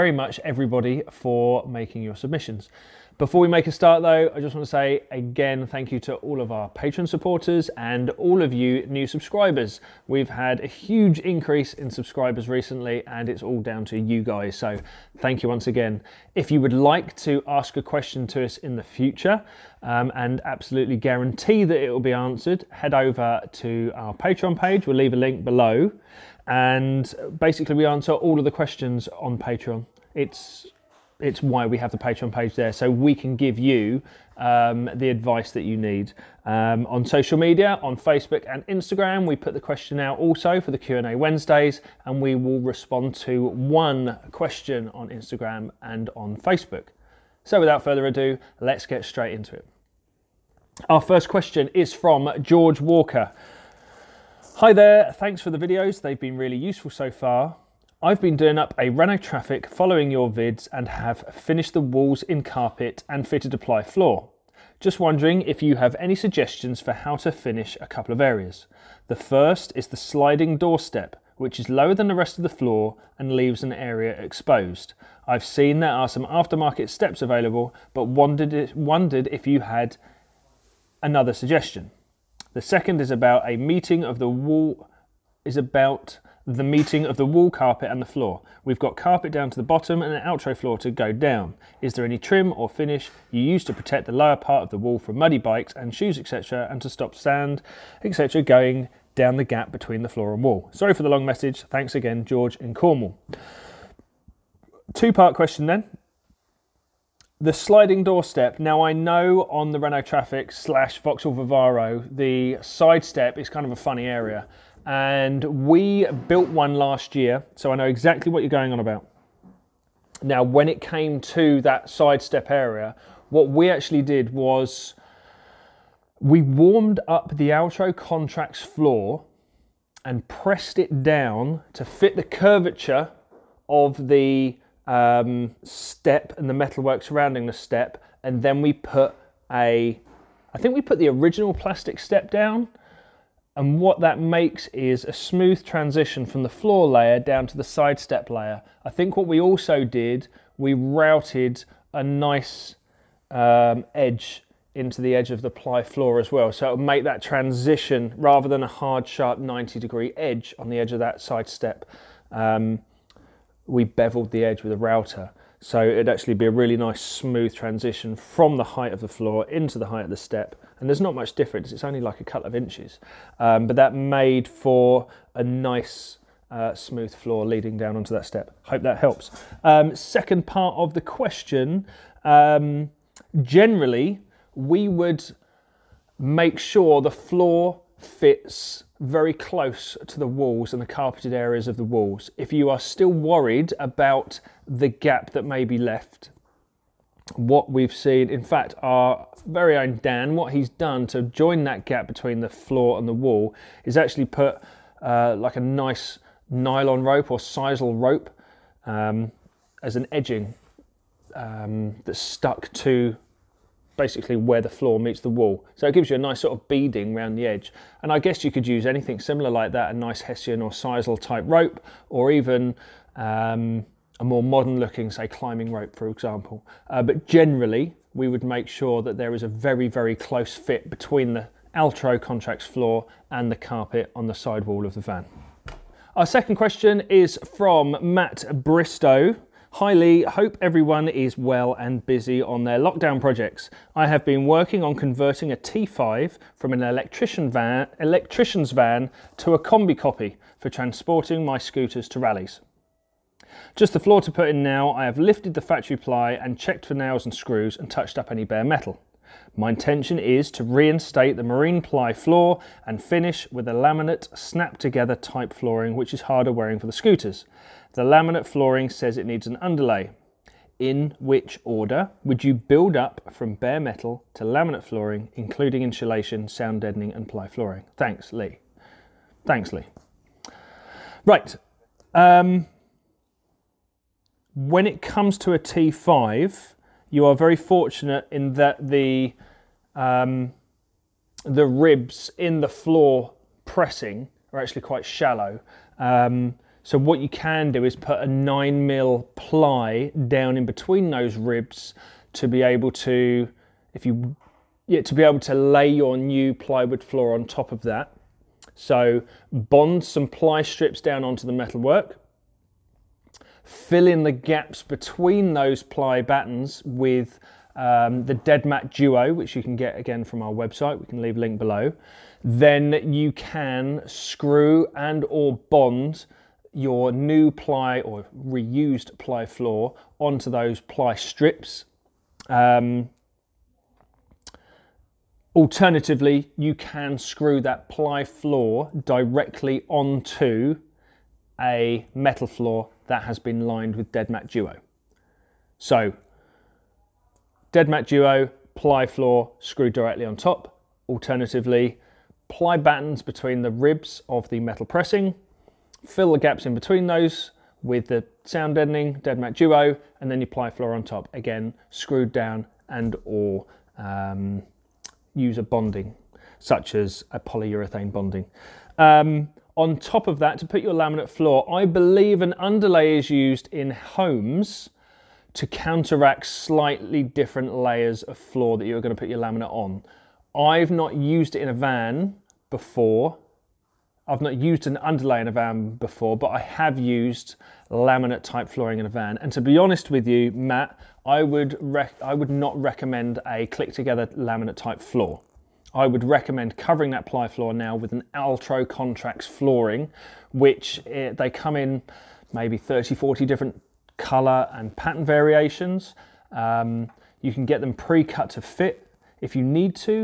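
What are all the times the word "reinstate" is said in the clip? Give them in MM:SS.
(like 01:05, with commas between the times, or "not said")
04:20.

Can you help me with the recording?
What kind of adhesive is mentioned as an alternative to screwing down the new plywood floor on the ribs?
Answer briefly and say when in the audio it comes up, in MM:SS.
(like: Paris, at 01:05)
Polyurethane bonding, at 06:07.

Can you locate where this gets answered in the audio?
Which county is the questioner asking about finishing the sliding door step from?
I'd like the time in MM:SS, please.
01:42.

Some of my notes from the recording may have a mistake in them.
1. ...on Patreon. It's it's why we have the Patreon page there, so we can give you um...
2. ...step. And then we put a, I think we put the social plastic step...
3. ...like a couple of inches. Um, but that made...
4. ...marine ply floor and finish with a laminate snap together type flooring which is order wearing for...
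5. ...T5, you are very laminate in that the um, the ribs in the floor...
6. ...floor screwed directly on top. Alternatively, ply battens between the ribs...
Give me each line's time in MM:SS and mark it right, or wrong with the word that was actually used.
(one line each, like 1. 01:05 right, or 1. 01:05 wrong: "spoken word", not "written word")
1. 00:29 right
2. 02:17 wrong: "original", not "social"
3. 02:51 right
4. 04:21 wrong: "harder", not "order"
5. 04:45 wrong: "fortunate", not "laminate"
6. 05:49 right.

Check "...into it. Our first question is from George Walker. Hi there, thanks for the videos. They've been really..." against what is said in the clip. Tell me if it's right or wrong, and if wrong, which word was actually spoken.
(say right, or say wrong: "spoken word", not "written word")
right.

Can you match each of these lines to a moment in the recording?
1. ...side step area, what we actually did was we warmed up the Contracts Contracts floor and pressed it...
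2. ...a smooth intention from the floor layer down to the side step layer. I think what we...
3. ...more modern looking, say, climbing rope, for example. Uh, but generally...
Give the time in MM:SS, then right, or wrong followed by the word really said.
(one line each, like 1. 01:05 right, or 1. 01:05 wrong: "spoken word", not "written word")
1. 02:01 wrong: "Altro", not "Contracts"
2. 02:25 wrong: "transition", not "intention"
3. 03:44 right.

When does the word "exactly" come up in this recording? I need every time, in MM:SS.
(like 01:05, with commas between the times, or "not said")
01:57.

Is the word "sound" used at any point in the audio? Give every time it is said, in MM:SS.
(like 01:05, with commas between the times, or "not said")
04:36, 05:58.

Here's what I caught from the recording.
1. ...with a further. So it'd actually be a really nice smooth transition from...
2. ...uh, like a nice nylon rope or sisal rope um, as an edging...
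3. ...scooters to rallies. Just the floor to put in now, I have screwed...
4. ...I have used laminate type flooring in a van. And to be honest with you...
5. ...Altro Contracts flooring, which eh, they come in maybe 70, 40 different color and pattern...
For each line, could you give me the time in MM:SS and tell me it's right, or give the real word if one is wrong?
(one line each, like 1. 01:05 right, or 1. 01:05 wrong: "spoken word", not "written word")
1. 02:44 wrong: "router", not "further"
2. 03:25 right
3. 04:11 wrong: "lifted", not "screwed"
4. 06:26 right
5. 06:38 wrong: "30", not "70".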